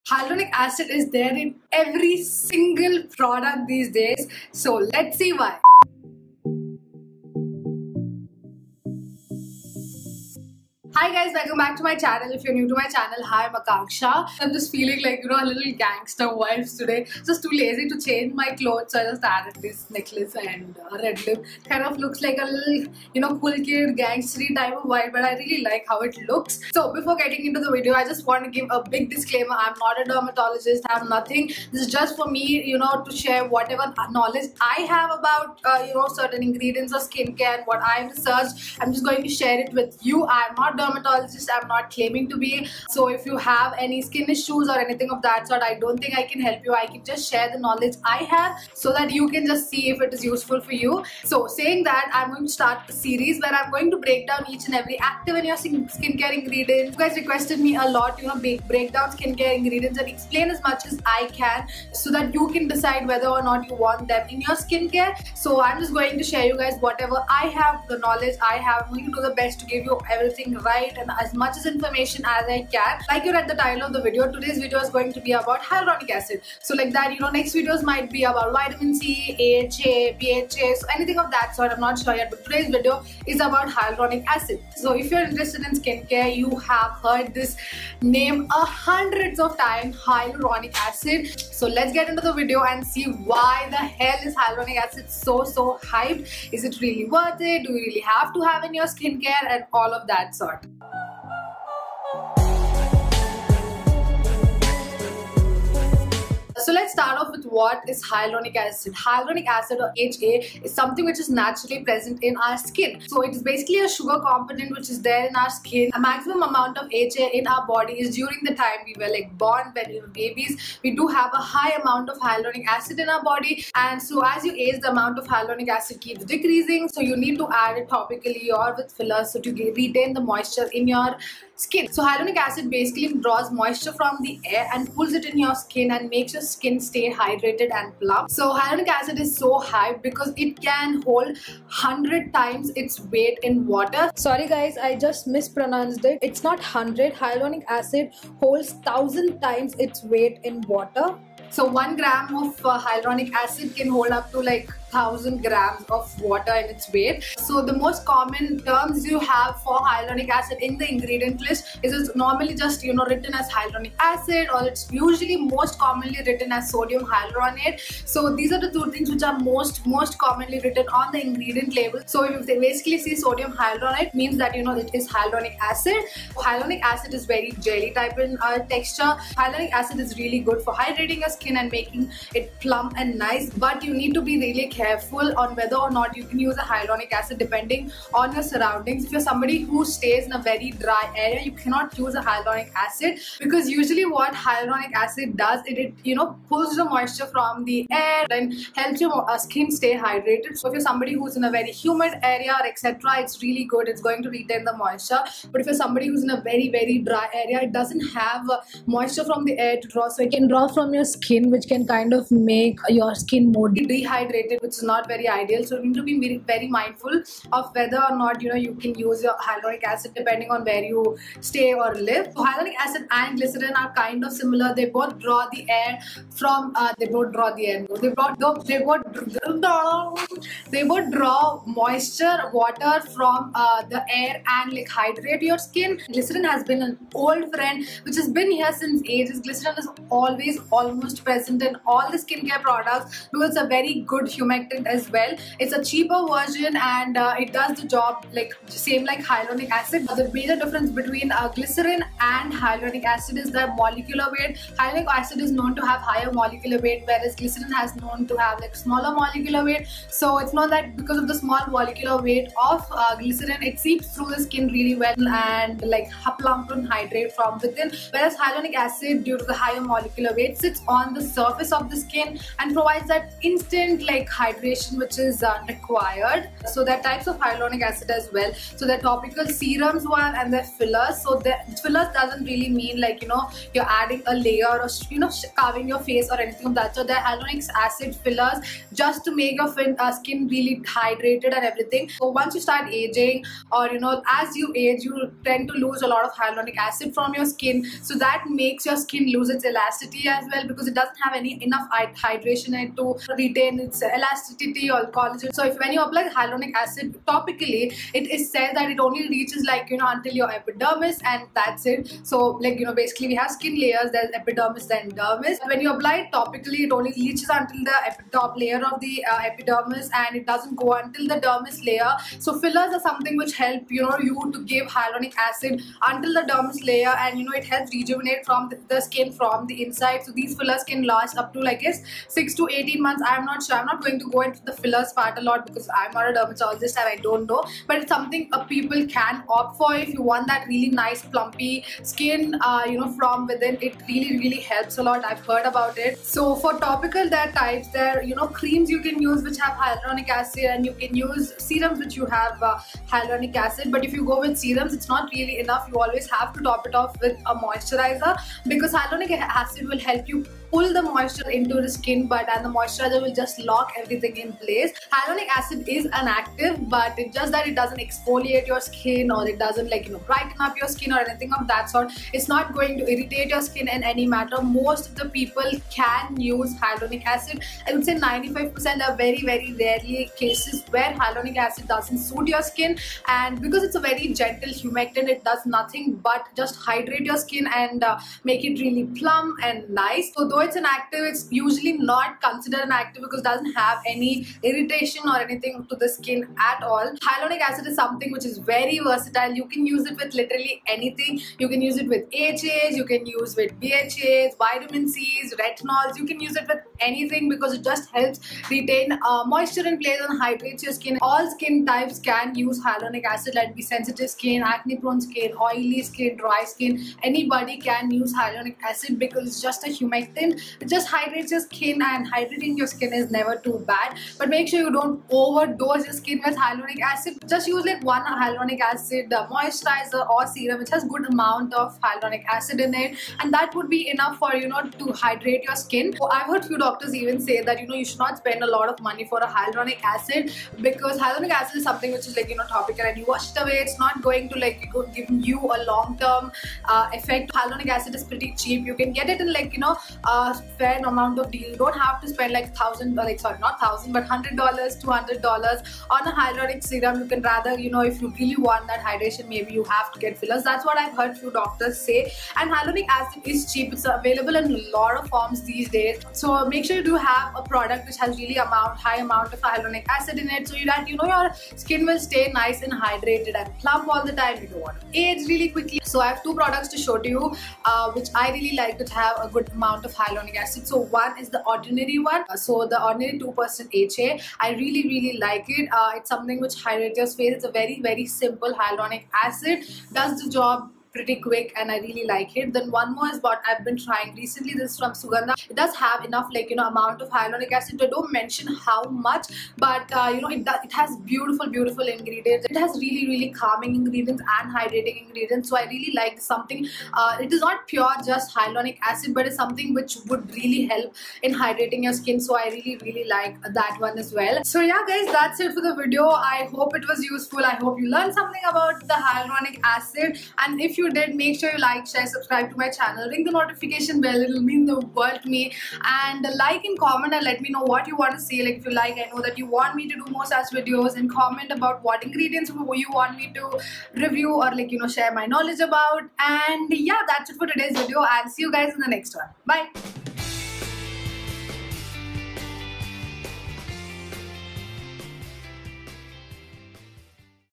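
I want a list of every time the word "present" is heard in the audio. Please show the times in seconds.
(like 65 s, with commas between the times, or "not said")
111 s, 241 s.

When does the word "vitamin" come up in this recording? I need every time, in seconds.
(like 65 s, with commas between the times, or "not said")
78 s, 404 s.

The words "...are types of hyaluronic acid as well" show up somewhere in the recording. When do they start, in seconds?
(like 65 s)
276 s.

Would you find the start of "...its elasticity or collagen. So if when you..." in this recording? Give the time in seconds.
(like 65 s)
303 s.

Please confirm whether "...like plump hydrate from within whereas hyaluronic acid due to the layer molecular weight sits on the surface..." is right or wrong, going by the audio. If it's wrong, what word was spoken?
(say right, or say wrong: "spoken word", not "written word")
wrong: "higher", not "layer".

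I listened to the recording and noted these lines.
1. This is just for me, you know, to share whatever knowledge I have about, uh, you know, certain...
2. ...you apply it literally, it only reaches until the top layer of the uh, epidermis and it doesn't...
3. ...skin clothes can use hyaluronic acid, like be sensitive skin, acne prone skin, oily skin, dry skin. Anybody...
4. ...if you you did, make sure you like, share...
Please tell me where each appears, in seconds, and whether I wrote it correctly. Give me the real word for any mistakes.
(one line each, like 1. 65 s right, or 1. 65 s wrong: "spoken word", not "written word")
1. 31 s right
2. 315 s wrong: "topically", not "literally"
3. 411 s wrong: "types", not "clothes"
4. 520 s right.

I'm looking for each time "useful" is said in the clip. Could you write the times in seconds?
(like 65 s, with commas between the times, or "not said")
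50 s, 517 s.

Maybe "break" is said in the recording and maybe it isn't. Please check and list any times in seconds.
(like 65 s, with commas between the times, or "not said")
53 s, 58 s.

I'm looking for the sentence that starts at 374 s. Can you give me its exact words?
Most of the people can use hyaluronic acid.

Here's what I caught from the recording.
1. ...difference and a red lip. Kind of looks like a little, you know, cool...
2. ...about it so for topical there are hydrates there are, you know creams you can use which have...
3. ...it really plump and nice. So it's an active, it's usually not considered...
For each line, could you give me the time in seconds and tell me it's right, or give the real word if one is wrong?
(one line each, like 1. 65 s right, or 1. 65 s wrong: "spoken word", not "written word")
1. 19 s wrong: "necklace", not "difference"
2. 345 s wrong: "types", not "hydrates"
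3. 388 s right.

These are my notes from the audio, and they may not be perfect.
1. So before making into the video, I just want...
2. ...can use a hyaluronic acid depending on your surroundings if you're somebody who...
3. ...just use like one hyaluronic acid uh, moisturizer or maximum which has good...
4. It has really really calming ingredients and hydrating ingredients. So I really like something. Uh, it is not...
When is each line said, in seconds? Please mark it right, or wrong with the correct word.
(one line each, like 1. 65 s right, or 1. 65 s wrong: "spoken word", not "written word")
1. 26 s wrong: "getting", not "making"
2. 186 s right
3. 427 s wrong: "serum", not "maximum"
4. 502 s right.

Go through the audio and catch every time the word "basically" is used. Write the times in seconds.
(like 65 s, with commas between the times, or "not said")
113 s, 132 s, 172 s, 312 s.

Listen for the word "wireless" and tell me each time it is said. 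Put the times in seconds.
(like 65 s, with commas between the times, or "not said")
not said.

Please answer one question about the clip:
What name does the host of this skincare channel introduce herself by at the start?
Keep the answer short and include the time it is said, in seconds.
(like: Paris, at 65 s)
Akanksha, at 13 s.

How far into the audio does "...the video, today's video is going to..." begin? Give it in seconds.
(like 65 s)
73 s.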